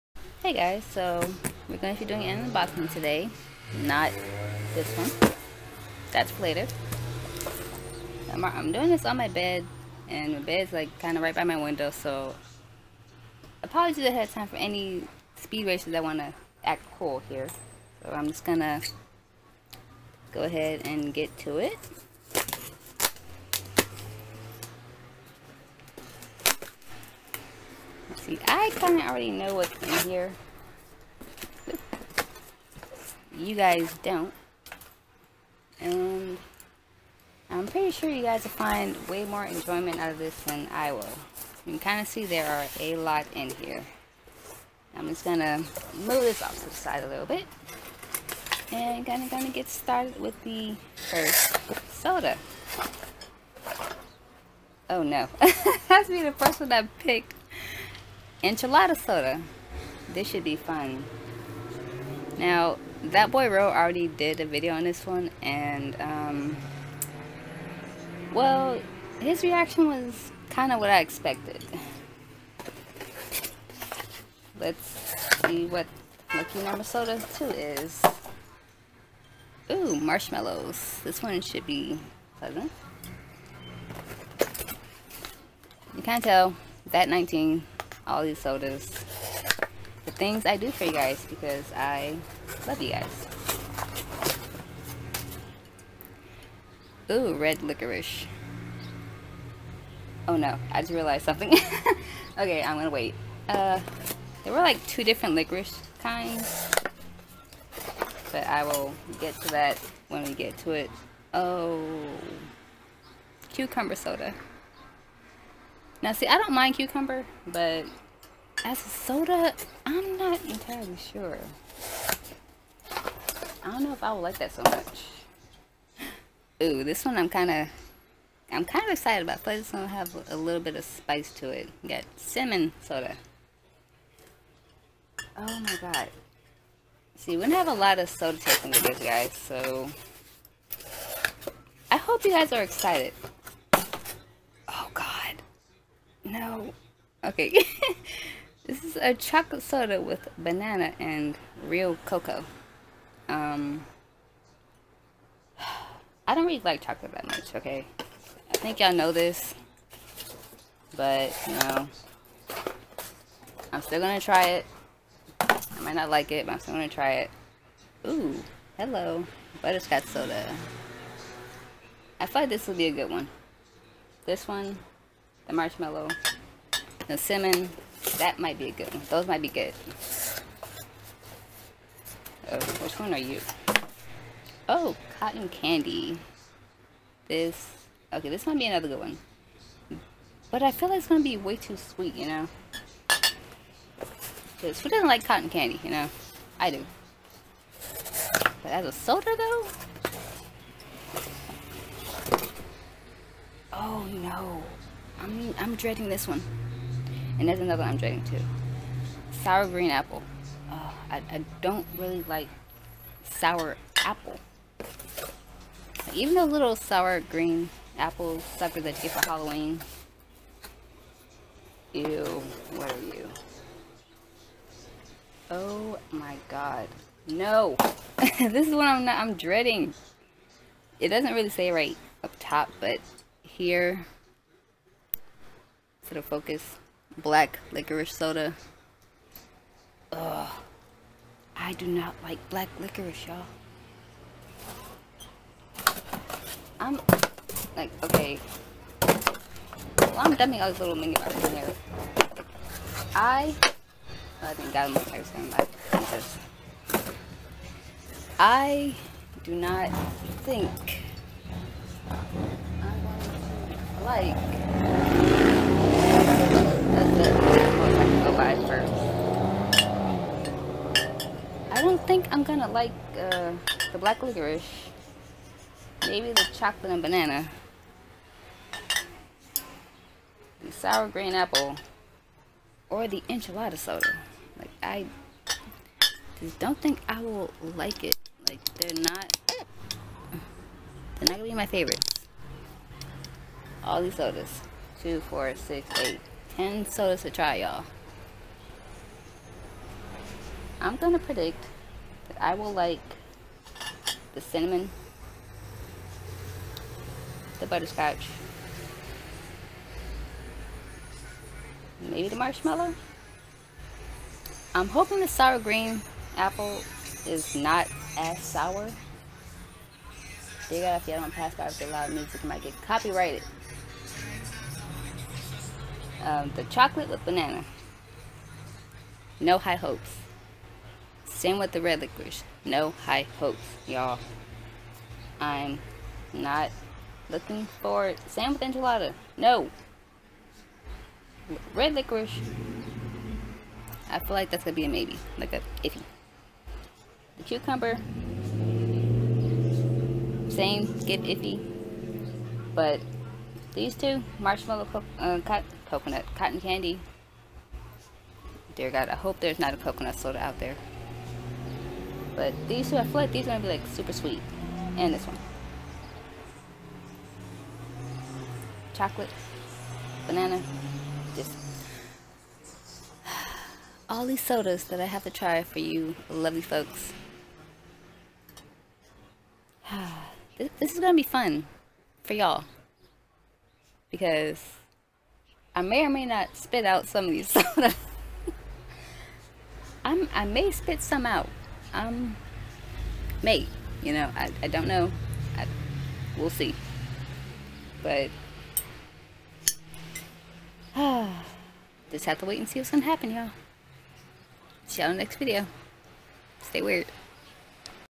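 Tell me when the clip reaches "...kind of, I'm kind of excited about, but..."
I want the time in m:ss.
2:07.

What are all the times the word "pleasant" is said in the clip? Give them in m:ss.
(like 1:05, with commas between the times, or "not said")
1:22.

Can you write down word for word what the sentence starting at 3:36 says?
Even the little sour green apple sucker that you get for Halloween.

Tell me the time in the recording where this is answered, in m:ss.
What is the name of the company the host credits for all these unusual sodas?
1:26.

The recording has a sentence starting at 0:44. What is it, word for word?
I'm just gonna move this off to the side a little bit.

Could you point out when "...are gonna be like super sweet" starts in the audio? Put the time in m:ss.
6:03.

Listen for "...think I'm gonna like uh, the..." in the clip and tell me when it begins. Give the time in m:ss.
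4:32.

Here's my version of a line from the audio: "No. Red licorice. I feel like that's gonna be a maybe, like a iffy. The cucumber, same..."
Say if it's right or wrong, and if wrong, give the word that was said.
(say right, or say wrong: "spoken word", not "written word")
right.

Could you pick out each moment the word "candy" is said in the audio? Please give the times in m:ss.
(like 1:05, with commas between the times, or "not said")
3:05, 3:15, 5:56.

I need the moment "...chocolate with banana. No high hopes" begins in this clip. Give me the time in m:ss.
5:26.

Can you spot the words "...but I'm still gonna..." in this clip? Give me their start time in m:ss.
2:46.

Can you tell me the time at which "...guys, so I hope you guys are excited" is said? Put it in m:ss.
2:18.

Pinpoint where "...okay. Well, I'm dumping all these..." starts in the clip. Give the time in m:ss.
4:08.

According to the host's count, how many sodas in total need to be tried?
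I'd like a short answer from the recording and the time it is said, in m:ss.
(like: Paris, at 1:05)
8, at 4:56.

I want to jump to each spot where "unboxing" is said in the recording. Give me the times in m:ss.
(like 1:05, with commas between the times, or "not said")
0:02.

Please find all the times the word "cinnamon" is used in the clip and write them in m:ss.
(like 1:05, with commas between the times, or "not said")
2:12, 2:57, 5:04.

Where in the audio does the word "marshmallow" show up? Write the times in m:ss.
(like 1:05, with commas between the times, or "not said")
1:19, 2:55, 5:12, 5:54.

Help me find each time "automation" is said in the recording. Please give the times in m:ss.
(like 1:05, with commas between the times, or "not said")
not said.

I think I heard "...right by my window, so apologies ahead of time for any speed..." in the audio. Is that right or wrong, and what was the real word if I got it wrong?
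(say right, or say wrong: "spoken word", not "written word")
right.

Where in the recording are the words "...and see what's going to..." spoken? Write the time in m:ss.
6:42.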